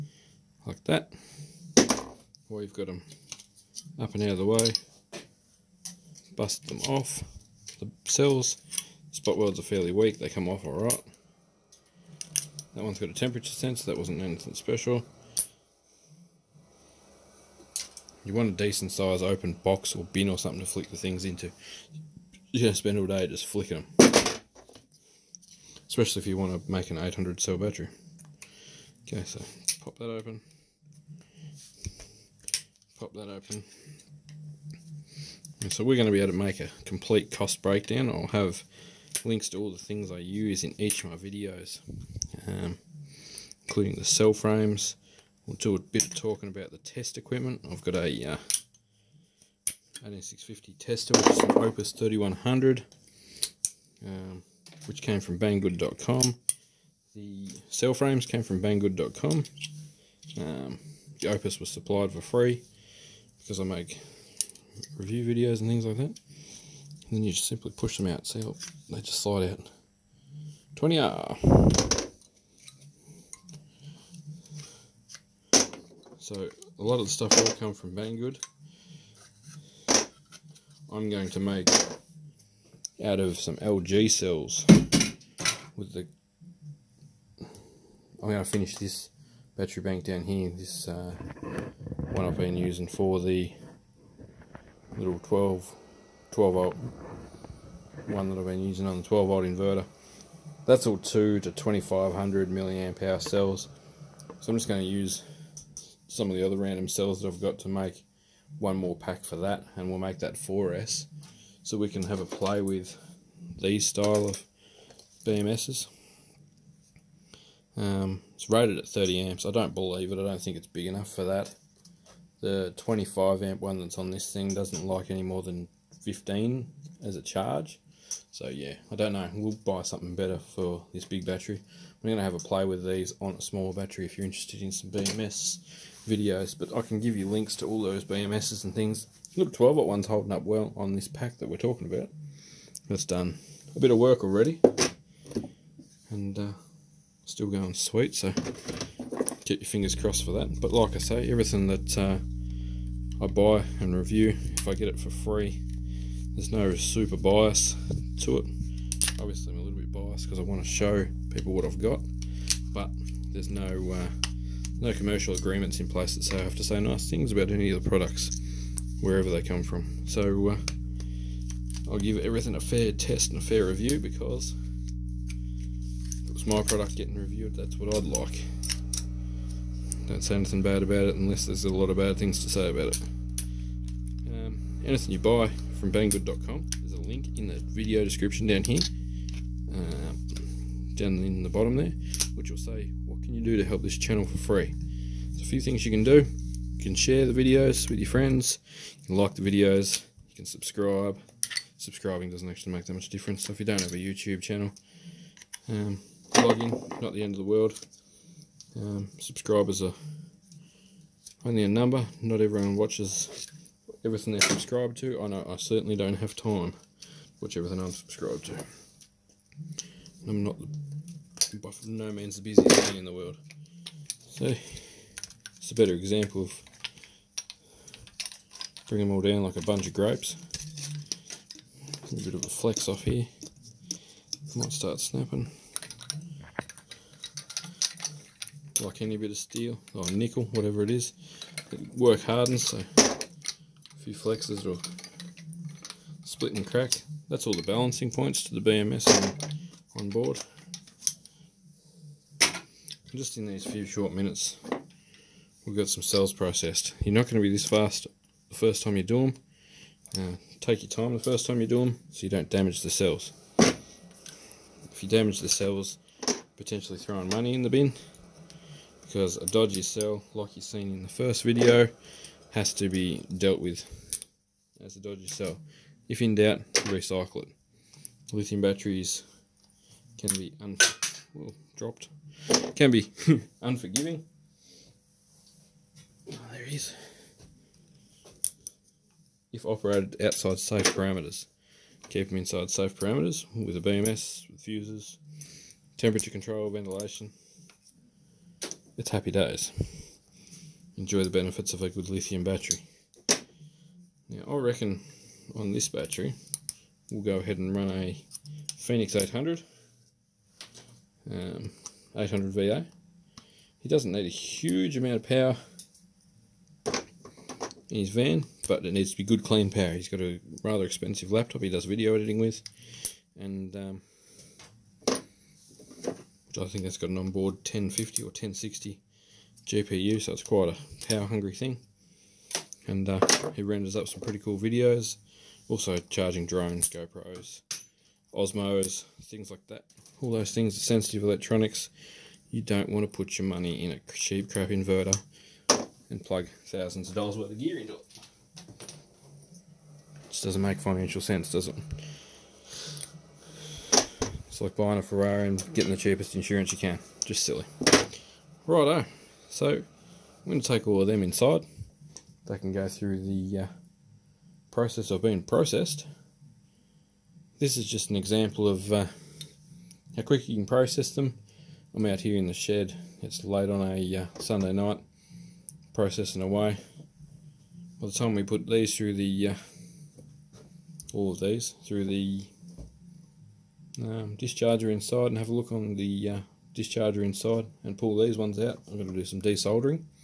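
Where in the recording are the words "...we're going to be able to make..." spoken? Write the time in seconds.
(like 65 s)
35 s.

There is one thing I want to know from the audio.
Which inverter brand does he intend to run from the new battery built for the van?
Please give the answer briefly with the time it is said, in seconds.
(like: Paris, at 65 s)
Phoenix, at 308 s.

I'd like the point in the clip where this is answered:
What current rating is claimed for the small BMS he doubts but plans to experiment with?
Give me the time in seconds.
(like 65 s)
118 s.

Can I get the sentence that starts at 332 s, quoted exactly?
And uh, he renders up some pretty cool videos, also charging drones, GoPros, Osmos, things like that.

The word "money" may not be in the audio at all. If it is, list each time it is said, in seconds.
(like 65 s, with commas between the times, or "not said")
267 s, 343 s.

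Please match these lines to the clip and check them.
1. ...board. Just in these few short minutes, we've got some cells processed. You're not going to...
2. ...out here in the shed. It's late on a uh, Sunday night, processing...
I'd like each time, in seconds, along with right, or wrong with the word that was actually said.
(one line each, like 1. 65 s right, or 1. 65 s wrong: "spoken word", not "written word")
1. 250 s right
2. 372 s right.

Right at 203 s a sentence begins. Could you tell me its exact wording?
So if you don't have a YouTube channel, um, not the end of the world.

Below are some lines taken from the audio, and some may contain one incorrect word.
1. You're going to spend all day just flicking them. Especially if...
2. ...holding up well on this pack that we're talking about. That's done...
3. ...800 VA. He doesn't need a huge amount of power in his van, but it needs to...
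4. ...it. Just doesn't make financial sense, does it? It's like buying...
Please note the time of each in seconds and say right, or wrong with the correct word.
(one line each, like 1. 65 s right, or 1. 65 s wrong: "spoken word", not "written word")
1. 22 s right
2. 140 s right
3. 312 s right
4. 347 s right.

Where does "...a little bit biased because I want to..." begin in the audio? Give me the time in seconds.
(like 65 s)
159 s.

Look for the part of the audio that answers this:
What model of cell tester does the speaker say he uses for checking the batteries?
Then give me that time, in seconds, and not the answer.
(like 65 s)
51 s.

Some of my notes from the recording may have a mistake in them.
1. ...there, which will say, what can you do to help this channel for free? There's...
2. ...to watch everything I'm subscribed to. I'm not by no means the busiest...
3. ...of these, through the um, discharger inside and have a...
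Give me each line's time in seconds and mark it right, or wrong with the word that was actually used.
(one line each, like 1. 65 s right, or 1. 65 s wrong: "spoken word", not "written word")
1. 191 s right
2. 216 s right
3. 381 s right.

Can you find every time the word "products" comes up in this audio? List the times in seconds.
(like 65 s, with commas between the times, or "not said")
167 s, 176 s.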